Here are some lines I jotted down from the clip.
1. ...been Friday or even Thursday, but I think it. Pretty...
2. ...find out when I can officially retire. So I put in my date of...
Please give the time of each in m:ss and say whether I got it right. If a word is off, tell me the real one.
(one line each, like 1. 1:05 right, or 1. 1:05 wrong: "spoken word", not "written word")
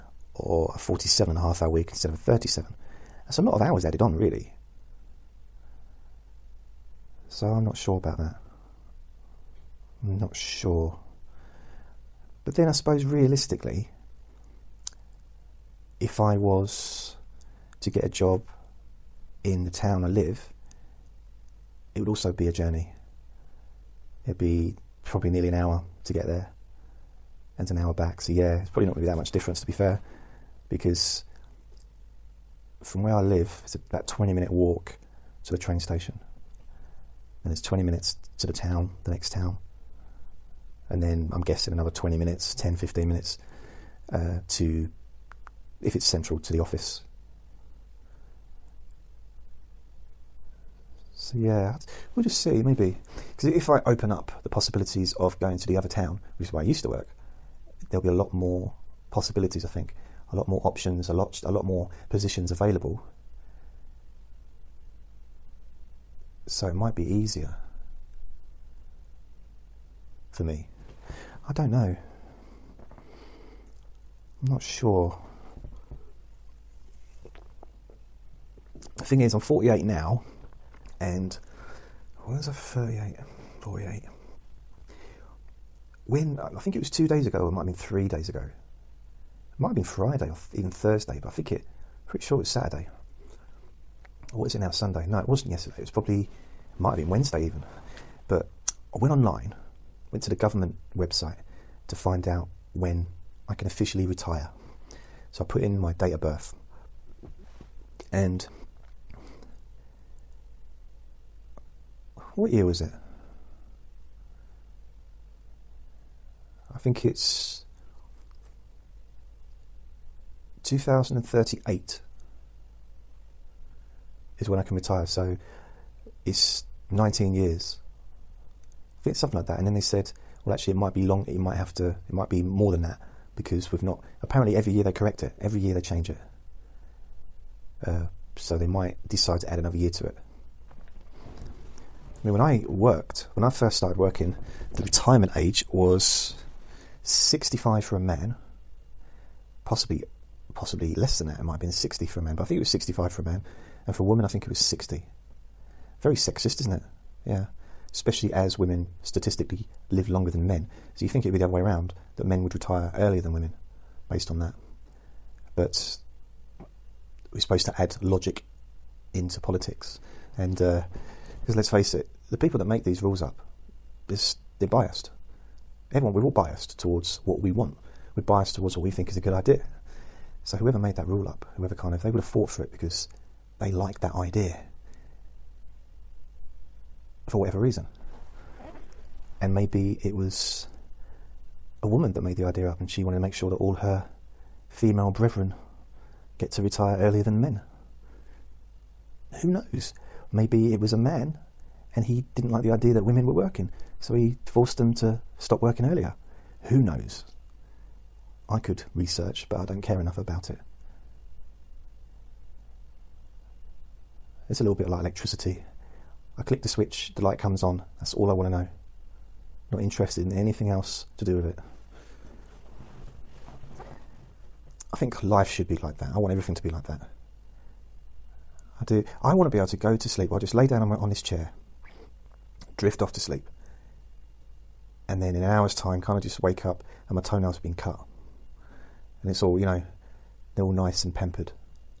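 1. 1:29 right
2. 1:41 right.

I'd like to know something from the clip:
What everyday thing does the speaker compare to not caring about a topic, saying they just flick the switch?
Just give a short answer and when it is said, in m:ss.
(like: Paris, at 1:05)
Electricity, at 3:35.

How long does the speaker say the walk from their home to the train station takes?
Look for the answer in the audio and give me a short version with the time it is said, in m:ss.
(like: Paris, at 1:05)
20 minutes, at 0:33.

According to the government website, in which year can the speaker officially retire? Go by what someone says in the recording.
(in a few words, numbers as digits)
2038.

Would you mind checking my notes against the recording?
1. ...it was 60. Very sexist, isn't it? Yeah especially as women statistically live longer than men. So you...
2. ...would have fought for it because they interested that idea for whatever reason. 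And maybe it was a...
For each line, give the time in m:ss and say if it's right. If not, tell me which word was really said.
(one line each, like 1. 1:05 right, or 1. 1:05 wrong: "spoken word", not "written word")
1. 2:34 right
2. 3:02 wrong: "liked", not "interested".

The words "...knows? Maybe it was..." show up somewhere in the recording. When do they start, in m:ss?
3:19.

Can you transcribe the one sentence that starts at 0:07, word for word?
So I'm not sure about that.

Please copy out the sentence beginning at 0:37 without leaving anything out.
Then it's 20 minutes to the town, the next town.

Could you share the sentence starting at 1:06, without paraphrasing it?
So it might be easier for me.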